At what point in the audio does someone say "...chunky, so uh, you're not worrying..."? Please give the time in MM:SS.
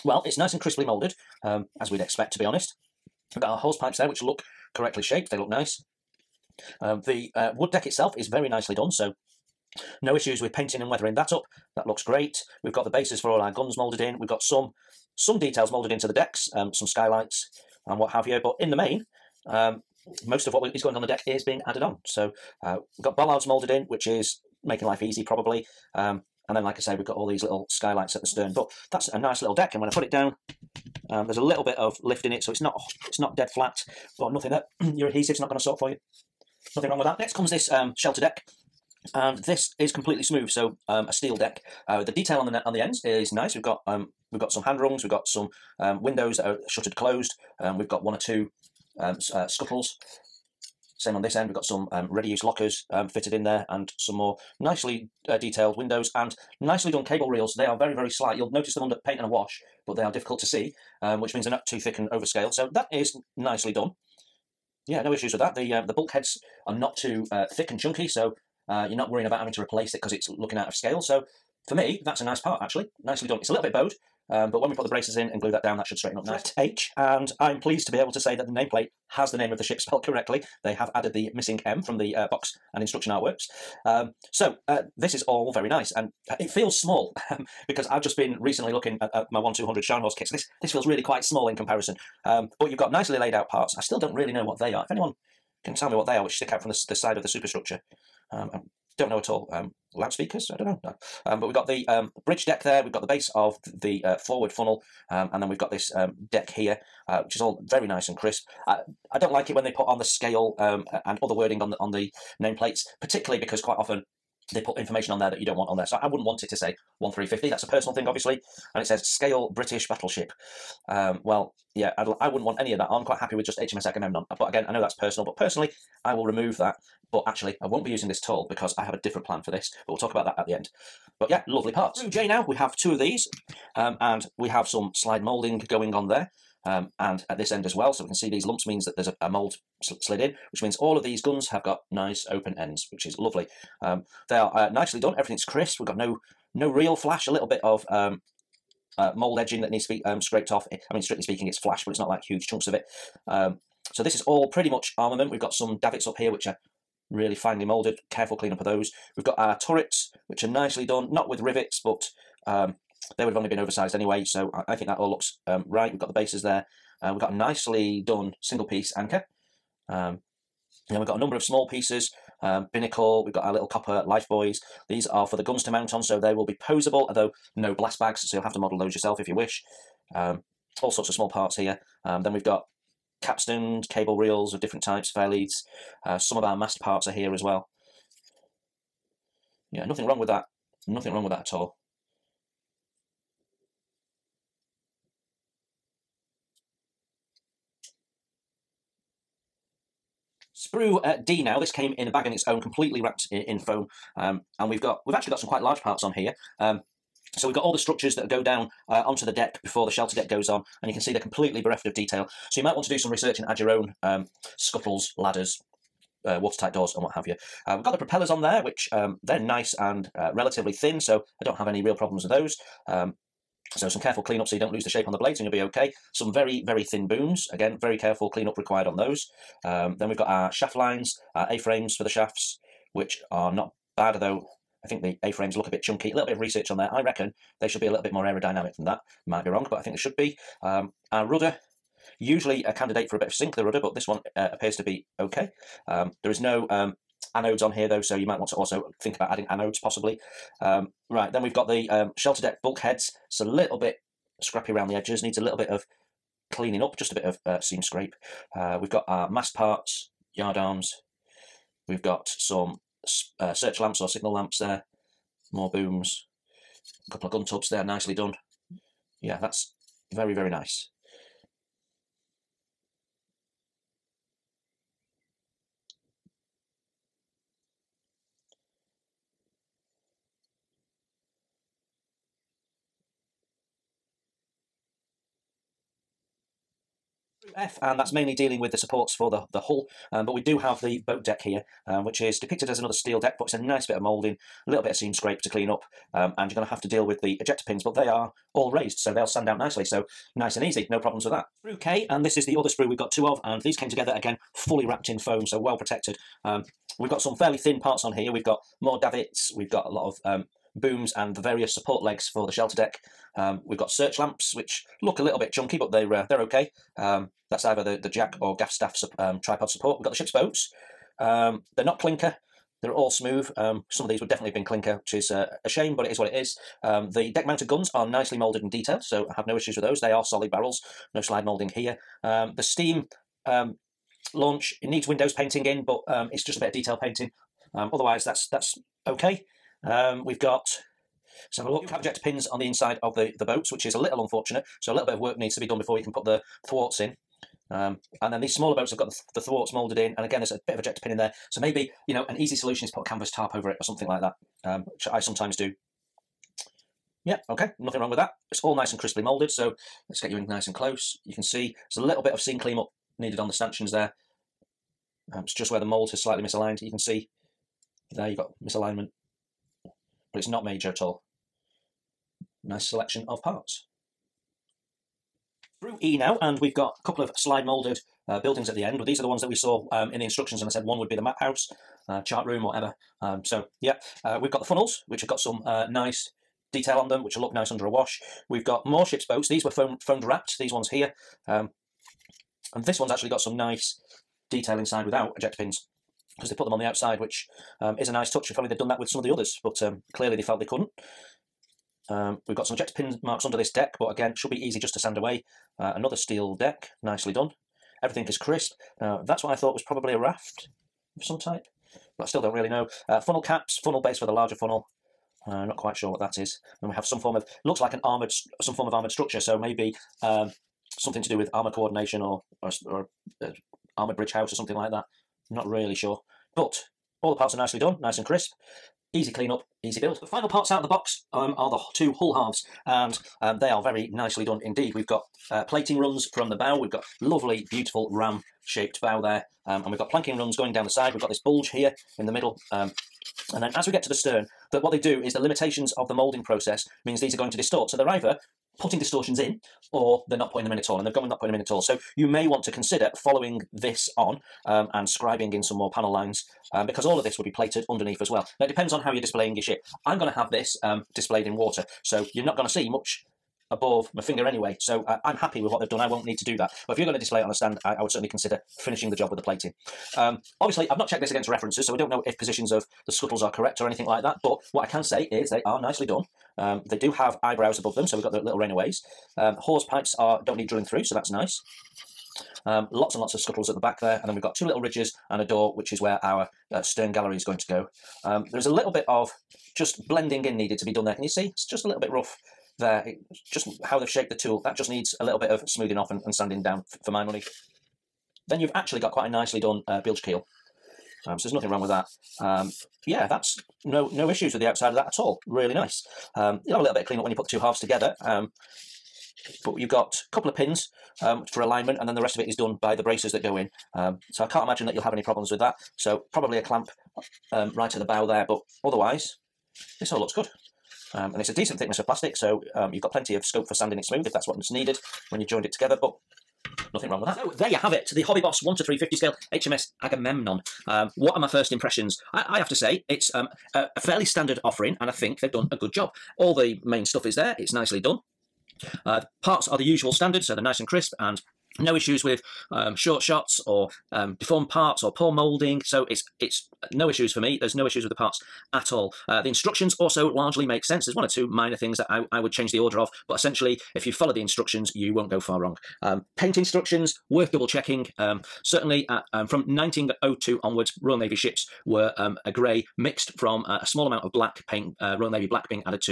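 01:07.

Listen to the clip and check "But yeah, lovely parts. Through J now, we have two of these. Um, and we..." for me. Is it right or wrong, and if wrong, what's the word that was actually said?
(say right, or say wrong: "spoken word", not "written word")
right.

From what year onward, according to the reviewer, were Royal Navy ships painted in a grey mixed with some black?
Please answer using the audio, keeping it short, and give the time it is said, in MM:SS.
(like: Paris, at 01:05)
1902, at 09:19.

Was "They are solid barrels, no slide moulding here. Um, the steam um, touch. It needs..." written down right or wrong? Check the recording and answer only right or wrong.
wrong.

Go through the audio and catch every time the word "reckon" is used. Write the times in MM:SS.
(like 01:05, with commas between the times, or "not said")
03:57.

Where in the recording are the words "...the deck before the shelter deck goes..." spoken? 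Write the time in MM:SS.
03:29.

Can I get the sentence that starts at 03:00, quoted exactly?
Um, all sorts of small parts here.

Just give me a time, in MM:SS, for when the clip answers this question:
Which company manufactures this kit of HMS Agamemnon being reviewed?
08:48.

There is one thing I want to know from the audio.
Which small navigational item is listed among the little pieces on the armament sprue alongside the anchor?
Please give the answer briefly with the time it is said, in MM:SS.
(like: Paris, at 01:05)
Binnacle, at 02:52.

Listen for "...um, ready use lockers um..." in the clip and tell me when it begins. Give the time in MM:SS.
00:51.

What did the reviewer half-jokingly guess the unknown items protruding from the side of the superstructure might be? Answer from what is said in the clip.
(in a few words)
Loudspeakers.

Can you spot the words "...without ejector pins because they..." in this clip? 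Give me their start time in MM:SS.
06:35.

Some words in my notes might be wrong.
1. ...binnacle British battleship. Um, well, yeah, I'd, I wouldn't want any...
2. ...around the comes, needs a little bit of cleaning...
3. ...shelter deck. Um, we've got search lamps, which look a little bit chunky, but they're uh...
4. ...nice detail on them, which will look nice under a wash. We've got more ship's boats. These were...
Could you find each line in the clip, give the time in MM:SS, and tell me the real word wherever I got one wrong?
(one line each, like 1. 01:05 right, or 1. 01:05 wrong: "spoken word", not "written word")
1. 01:59 wrong: "scale", not "binnacle"
2. 04:14 wrong: "edges", not "comes"
3. 05:12 right
4. 06:25 right.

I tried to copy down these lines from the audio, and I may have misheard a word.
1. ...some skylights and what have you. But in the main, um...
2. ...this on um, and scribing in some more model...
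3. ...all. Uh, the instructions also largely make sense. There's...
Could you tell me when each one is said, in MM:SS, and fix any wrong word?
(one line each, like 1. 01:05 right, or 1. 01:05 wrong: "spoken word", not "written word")
1. 00:16 right
2. 07:33 wrong: "panel", not "model"
3. 09:08 right.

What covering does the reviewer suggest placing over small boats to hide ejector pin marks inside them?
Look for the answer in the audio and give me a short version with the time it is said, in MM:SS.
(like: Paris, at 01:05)
A canvas tarp, at 05:53.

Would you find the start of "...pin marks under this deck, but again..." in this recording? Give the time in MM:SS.
06:42.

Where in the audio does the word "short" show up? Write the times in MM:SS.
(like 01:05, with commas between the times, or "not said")
09:02.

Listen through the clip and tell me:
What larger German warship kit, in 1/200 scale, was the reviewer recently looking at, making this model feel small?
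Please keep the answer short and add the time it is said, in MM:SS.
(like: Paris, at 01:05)
Scharnhorst, at 01:29.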